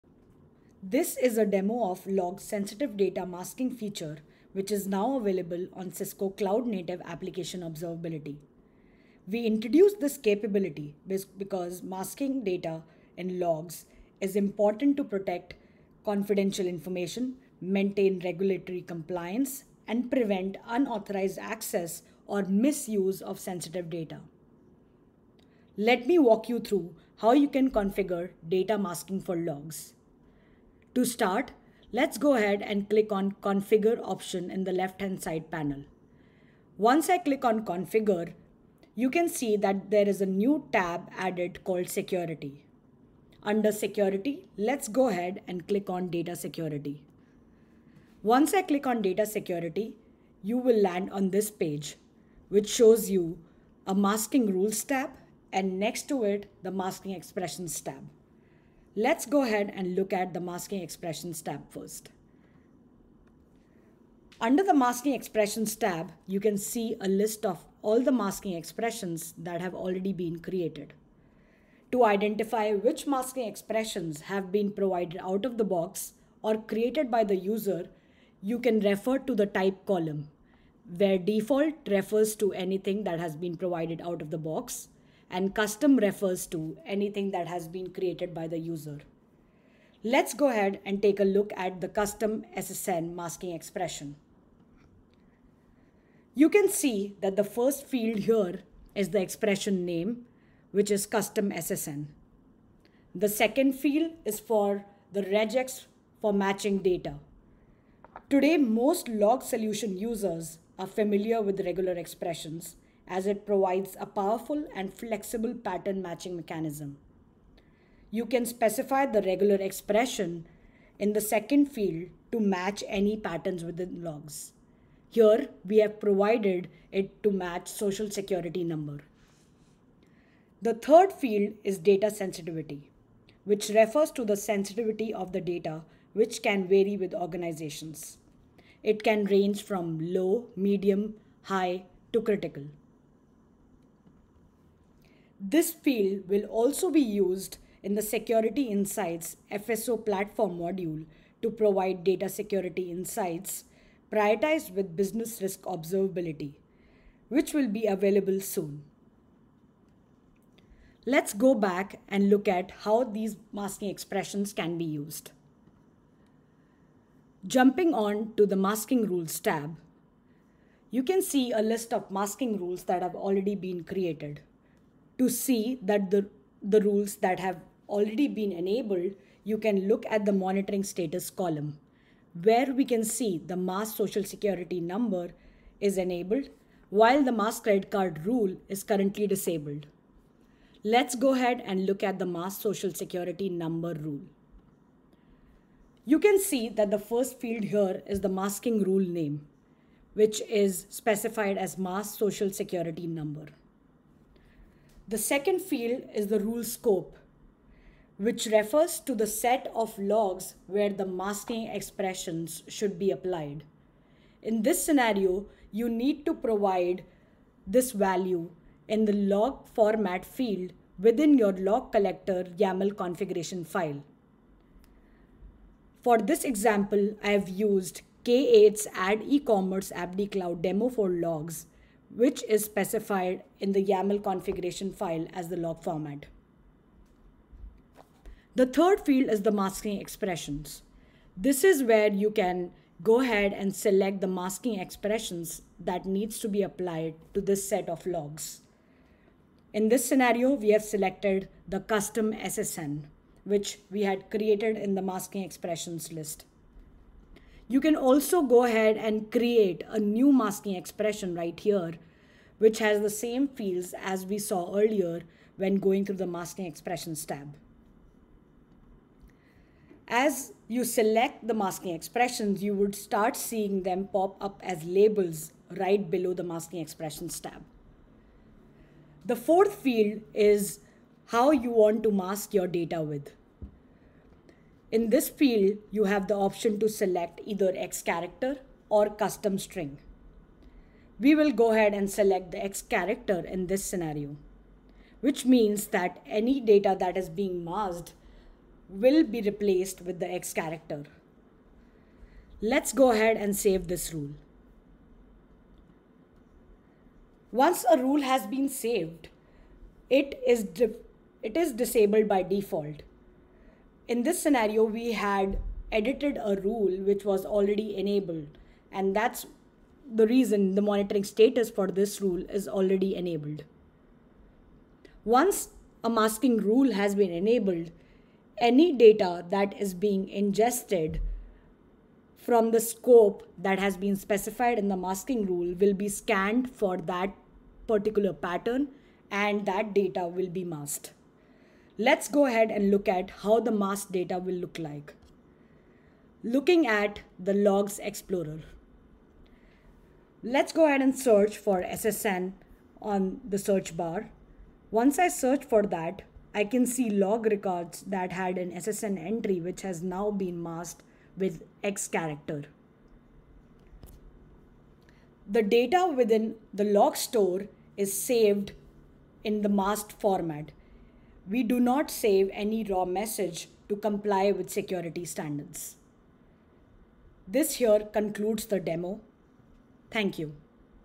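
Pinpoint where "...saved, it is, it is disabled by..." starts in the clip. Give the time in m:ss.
5:08.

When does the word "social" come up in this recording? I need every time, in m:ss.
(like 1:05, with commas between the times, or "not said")
2:07, 3:03, 3:12, 3:22.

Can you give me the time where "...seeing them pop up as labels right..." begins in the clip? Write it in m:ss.
4:33.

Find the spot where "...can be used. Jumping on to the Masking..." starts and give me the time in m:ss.
2:44.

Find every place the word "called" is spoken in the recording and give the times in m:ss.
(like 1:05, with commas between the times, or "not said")
0:41.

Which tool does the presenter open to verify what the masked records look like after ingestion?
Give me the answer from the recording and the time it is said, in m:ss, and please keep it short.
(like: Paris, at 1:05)
Logs explorer, at 5:47.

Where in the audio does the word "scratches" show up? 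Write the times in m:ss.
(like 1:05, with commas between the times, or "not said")
not said.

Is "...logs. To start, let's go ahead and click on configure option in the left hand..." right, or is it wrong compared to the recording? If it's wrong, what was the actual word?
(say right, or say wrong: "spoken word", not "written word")
right.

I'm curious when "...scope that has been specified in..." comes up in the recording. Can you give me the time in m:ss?
5:32.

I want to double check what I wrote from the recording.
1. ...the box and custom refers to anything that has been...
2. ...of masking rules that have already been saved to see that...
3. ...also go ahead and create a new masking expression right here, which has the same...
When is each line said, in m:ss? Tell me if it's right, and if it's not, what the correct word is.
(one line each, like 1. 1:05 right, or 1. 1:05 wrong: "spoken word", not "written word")
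1. 1:24 right
2. 2:51 wrong: "created", not "saved"
3. 4:17 right.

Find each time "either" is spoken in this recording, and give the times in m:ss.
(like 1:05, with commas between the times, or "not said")
4:47.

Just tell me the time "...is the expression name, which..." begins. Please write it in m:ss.
1:38.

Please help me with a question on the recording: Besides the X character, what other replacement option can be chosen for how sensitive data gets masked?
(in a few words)
Custom string.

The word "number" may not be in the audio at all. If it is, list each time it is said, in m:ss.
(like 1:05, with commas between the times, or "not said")
2:08, 3:04, 3:13, 3:23.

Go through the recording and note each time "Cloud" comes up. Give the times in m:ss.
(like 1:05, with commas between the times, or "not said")
0:06, 3:50.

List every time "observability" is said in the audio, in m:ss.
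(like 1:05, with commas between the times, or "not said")
0:07, 2:35.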